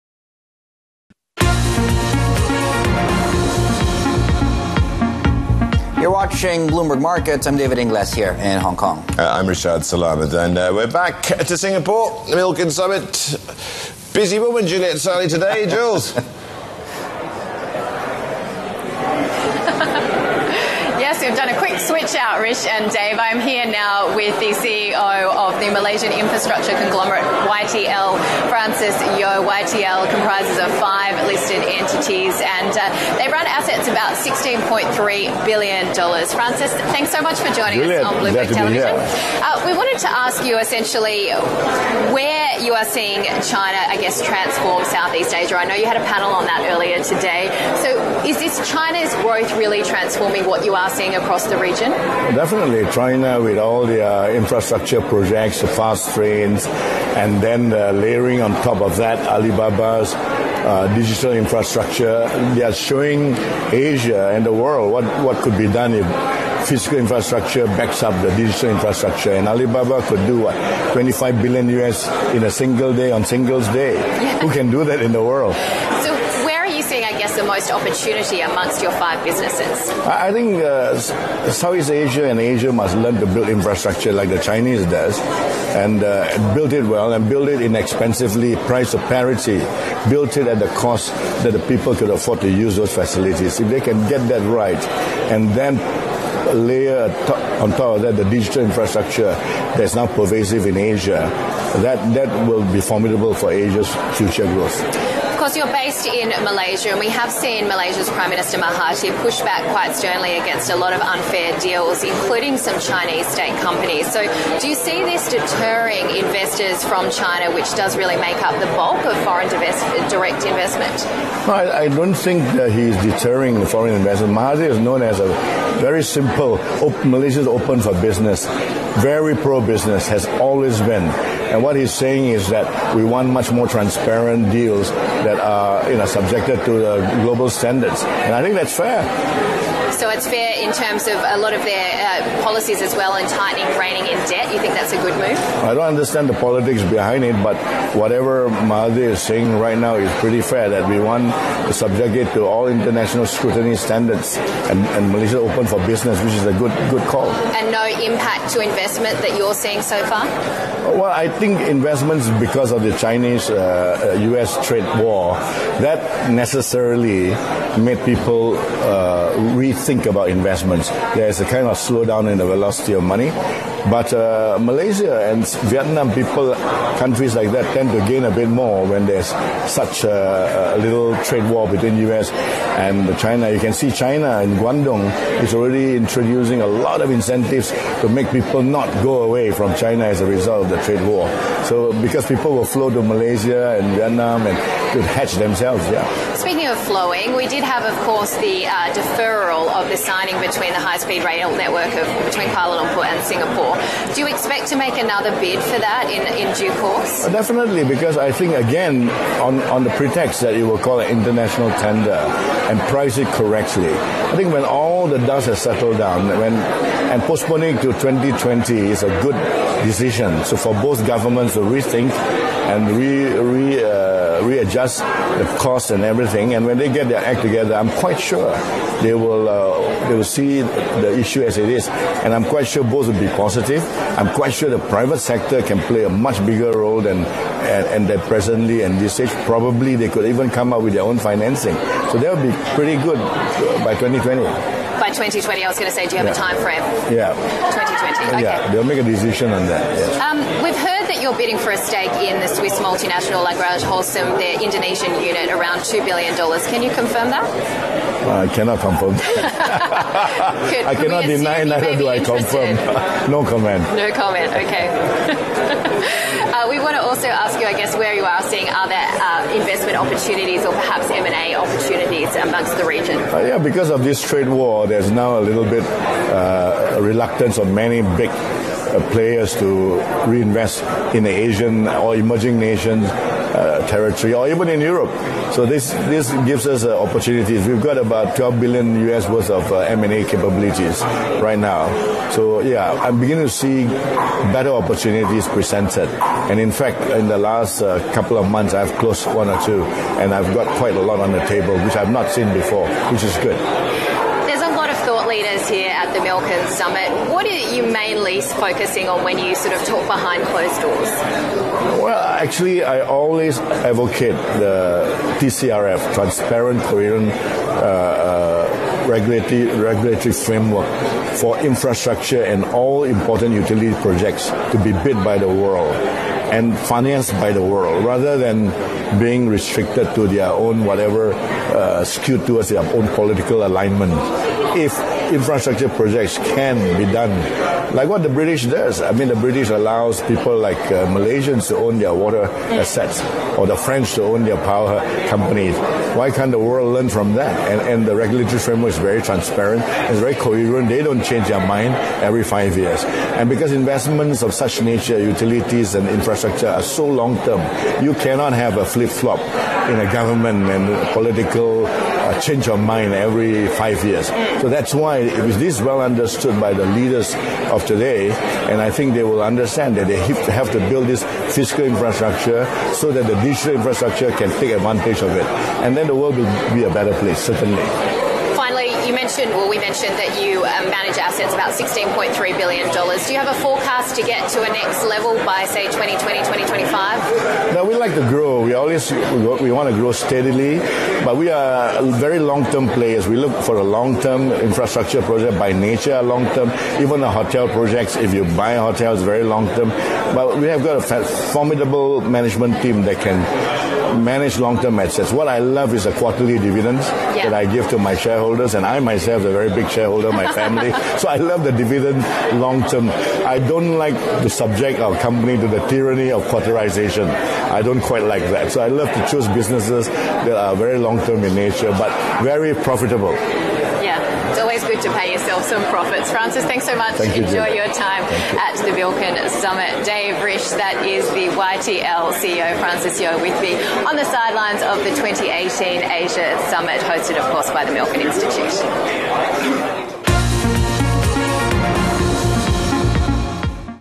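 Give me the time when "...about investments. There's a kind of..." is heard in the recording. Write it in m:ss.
2:50.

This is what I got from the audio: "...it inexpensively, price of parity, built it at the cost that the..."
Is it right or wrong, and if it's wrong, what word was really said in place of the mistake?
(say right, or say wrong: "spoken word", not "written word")
right.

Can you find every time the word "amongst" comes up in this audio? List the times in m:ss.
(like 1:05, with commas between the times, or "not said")
1:18, 4:32.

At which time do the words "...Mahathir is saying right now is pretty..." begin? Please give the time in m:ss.
2:28.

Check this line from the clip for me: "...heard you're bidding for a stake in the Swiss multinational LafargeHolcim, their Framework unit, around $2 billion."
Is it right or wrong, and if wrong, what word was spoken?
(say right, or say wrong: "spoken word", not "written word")
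wrong: "Indonesian", not "Framework".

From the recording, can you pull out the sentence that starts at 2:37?
And no impact to investment that you're seeing so far?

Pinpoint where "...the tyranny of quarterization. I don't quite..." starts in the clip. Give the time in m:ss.
6:55.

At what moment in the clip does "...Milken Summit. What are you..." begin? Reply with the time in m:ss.
5:06.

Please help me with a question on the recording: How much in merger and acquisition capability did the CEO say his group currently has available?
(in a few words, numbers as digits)
12 billion US.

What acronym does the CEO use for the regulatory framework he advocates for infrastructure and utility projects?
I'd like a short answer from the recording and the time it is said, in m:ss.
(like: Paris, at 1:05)
TCRF, at 5:15.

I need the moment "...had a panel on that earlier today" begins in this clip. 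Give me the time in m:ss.
0:45.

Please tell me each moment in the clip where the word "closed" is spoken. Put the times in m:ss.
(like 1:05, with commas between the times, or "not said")
4:58, 5:10.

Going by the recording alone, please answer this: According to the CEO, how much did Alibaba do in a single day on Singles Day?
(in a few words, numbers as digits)
25 billion US.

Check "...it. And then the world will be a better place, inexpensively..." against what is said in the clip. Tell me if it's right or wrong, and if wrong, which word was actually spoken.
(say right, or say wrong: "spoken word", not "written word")
wrong: "certainly", not "inexpensively".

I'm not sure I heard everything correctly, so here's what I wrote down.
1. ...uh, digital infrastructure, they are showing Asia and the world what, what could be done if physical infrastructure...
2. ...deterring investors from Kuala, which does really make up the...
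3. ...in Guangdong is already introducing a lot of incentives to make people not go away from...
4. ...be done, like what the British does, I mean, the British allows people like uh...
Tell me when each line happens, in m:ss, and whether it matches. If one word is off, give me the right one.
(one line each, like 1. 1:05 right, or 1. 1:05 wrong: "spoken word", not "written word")
1. 1:00 right
2. 1:55 wrong: "China", not "Kuala"
3. 3:04 right
4. 5:36 right.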